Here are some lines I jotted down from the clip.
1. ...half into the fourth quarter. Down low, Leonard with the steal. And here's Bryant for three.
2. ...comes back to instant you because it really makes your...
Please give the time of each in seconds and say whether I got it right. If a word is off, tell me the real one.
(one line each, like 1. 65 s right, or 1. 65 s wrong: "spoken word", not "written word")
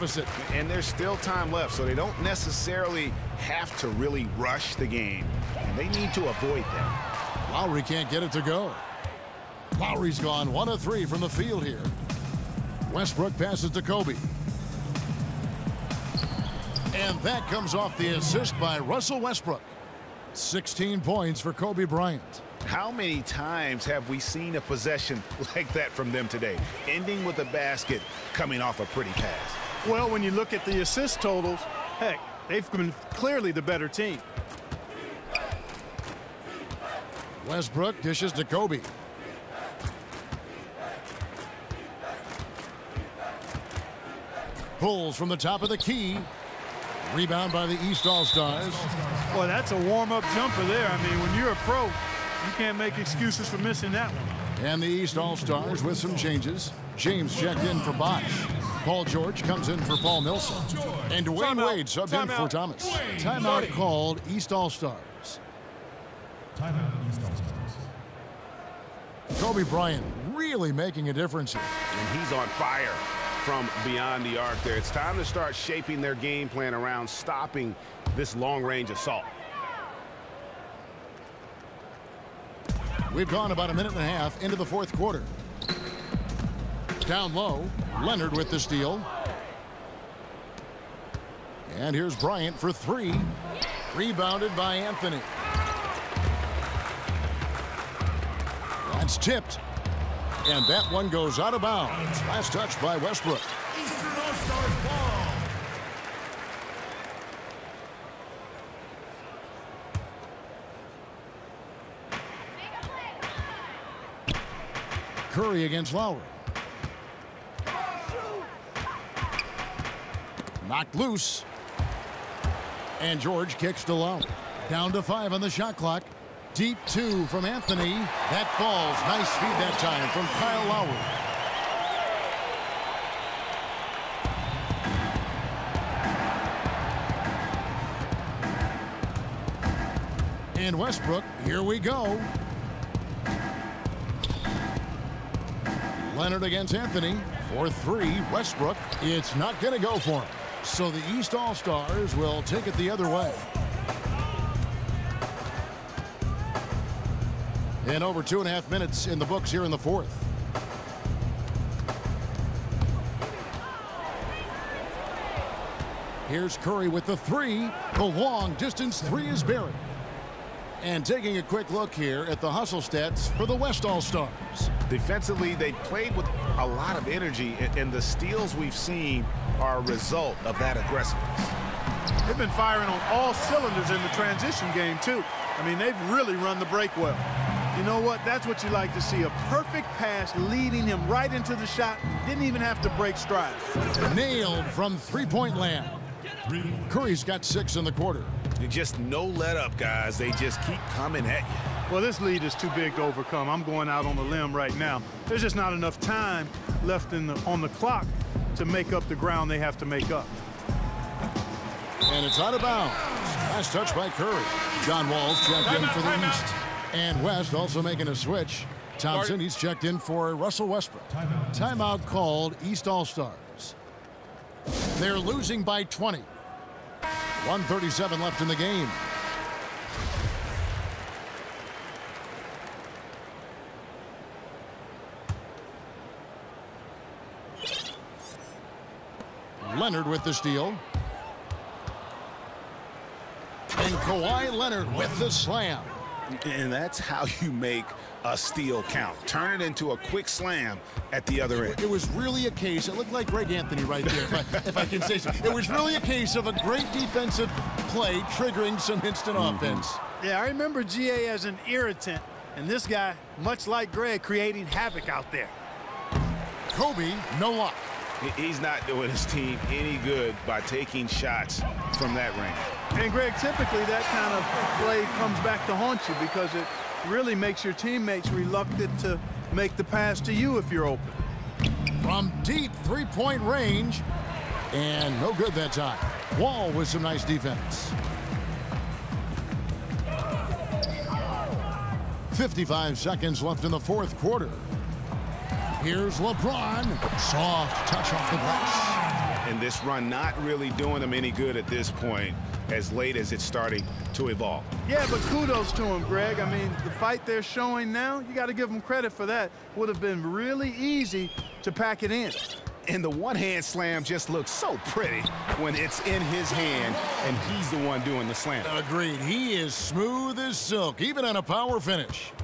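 1. 84 s right
2. 275 s wrong: "haunt", not "instant".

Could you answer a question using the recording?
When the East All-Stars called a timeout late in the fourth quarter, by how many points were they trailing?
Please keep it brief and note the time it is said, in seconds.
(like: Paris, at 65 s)
20, at 225 s.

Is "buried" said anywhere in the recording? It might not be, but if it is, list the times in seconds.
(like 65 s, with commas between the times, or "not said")
169 s.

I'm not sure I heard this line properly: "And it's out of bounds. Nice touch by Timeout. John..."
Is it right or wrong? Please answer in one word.
wrong.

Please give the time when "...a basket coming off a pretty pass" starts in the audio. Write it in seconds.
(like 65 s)
27 s.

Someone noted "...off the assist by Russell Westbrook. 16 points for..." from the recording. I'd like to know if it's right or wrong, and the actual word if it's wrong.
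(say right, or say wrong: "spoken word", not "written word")
right.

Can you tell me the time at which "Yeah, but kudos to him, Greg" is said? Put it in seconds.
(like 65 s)
304 s.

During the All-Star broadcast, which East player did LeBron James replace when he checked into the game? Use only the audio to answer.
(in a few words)
Bosh.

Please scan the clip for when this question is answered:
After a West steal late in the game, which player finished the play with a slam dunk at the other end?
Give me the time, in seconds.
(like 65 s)
244 s.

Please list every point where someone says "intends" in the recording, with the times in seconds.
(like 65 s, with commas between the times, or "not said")
not said.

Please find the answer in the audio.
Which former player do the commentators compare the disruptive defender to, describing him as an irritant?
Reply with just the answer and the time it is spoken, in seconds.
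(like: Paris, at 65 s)
Greg Anthony, at 253 s.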